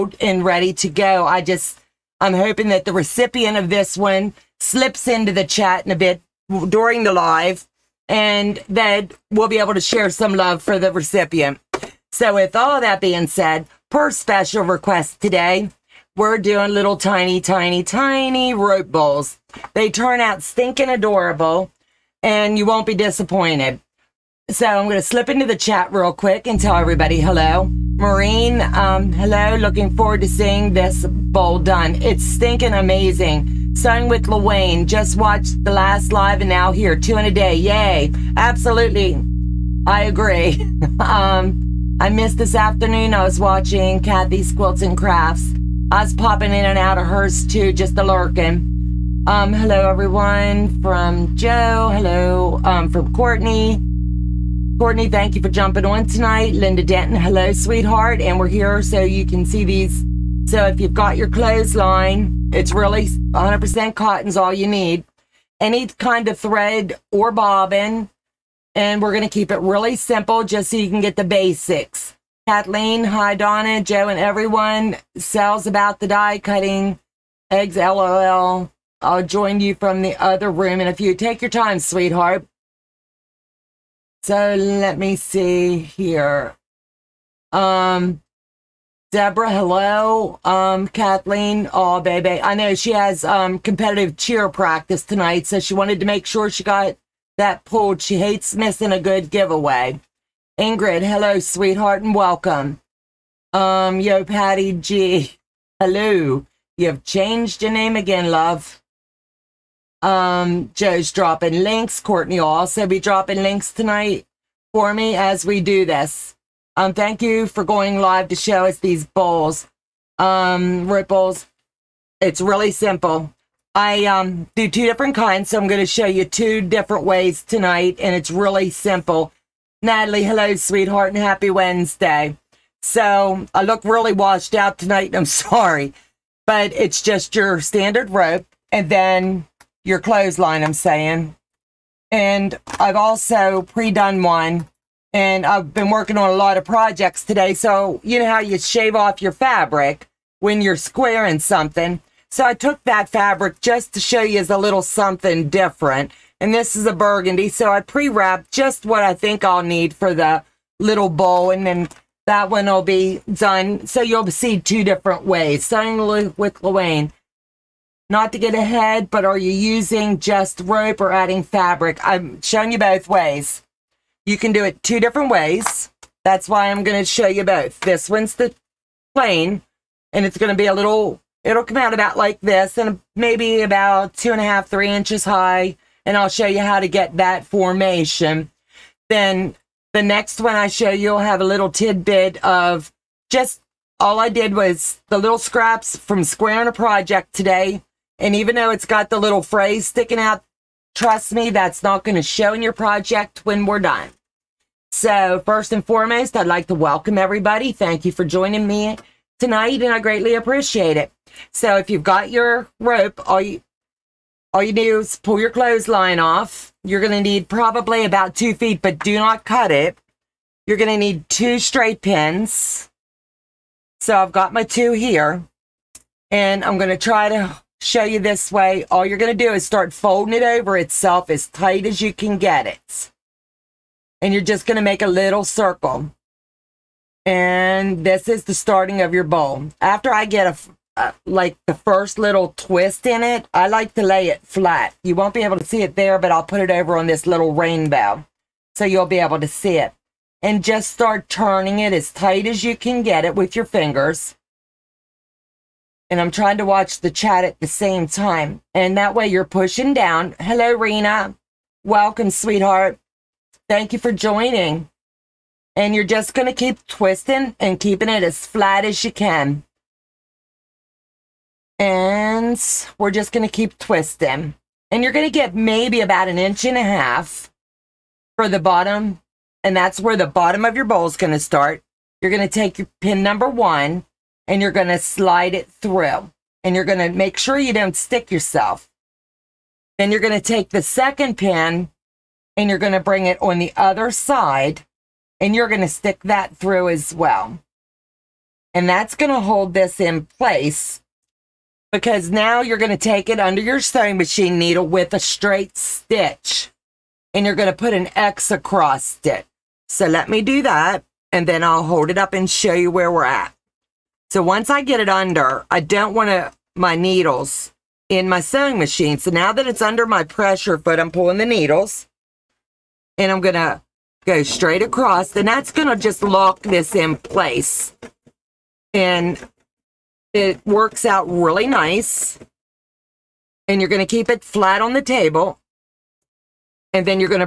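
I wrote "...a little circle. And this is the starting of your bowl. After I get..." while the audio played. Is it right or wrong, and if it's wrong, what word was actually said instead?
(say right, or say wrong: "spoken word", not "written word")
right.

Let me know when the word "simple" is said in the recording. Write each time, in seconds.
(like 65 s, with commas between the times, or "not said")
69 s, 122 s, 128 s.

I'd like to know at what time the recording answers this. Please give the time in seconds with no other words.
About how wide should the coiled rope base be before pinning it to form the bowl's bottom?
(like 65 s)
276 s.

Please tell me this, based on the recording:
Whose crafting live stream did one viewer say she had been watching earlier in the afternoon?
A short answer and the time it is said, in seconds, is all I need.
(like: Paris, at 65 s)
Kathy's Quilts and Crafts, at 43 s.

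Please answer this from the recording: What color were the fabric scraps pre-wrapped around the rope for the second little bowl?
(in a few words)
burgundy.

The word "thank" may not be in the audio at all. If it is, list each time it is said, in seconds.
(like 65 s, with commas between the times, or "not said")
55 s, 116 s, 207 s, 263 s.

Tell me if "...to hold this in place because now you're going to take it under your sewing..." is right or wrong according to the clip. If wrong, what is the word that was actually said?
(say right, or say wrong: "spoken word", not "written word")
right.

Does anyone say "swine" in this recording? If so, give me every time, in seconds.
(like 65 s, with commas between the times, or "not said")
not said.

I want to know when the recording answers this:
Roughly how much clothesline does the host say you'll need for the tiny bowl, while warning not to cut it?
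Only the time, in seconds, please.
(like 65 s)
218 s.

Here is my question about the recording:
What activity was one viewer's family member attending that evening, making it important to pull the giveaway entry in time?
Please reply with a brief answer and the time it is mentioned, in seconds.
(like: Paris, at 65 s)
competitive cheer practice, at 93 s.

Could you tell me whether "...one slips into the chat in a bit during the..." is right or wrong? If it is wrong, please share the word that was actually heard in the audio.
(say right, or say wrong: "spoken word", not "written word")
right.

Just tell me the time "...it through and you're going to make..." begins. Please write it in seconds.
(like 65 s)
285 s.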